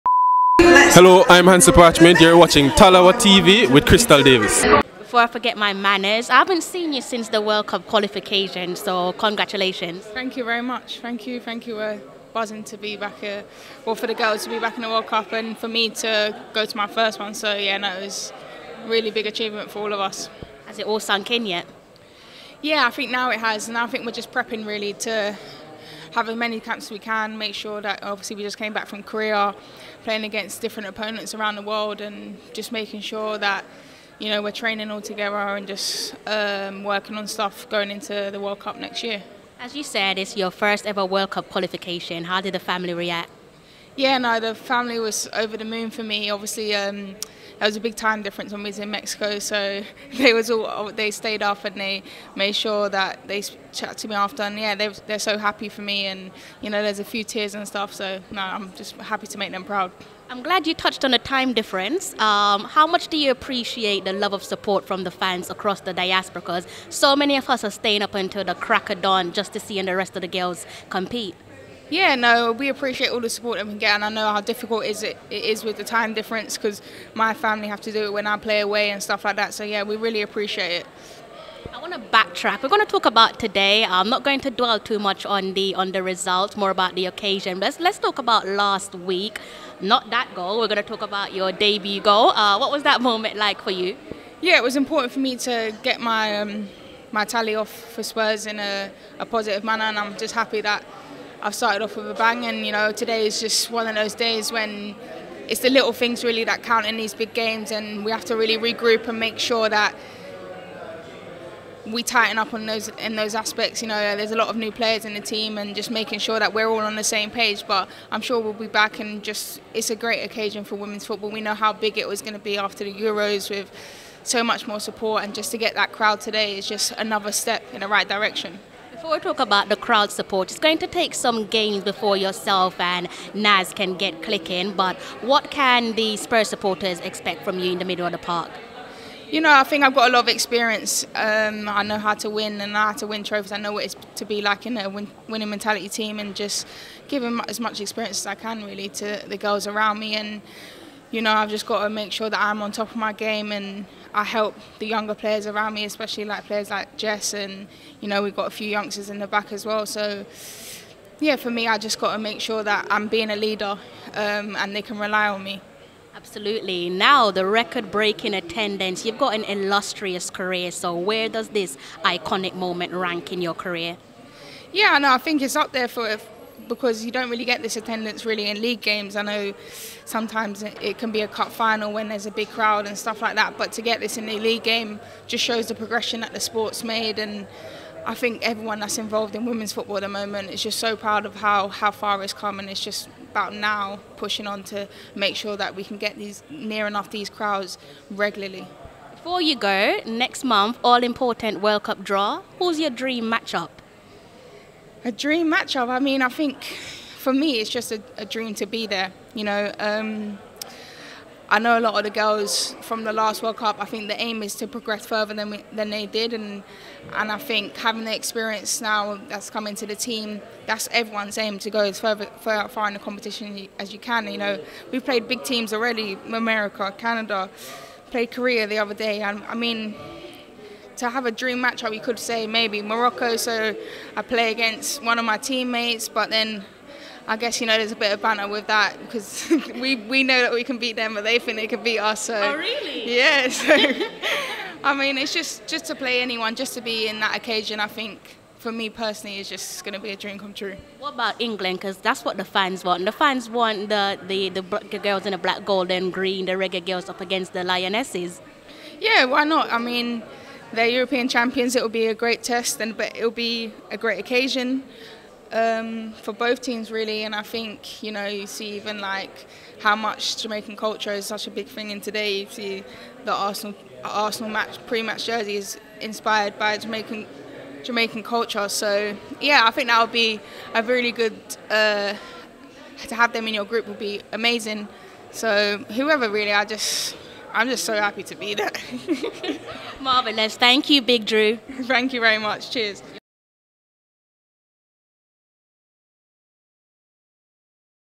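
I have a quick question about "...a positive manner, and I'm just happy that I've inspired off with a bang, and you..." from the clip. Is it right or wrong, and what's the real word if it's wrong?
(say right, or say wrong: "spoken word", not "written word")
wrong: "started", not "inspired".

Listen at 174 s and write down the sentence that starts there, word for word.
Yeah, no, I think it's up there for because you don't really get this attendance really in league games.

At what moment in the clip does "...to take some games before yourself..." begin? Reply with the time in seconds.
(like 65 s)
130 s.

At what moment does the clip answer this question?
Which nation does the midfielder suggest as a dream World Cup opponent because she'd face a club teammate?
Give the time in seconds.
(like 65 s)
232 s.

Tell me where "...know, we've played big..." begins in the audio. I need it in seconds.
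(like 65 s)
224 s.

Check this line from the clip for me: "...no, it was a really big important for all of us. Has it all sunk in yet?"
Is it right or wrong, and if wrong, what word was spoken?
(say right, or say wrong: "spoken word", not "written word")
wrong: "achievement", not "important".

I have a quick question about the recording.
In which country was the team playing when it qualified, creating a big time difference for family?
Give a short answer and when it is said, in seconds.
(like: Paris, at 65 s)
Mexico, at 48 s.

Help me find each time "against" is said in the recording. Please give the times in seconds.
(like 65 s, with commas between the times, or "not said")
30 s, 234 s, 257 s.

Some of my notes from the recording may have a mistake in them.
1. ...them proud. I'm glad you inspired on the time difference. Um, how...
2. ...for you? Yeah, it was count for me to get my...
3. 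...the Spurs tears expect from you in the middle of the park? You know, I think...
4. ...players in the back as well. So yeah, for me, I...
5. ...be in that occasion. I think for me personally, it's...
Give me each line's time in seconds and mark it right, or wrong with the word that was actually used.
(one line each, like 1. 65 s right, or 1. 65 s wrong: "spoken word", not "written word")
1. 59 s wrong: "touched", not "inspired"
2. 93 s wrong: "important", not "count"
3. 135 s wrong: "supporters", not "tears"
4. 158 s wrong: "youngsters", not "players"
5. 246 s right.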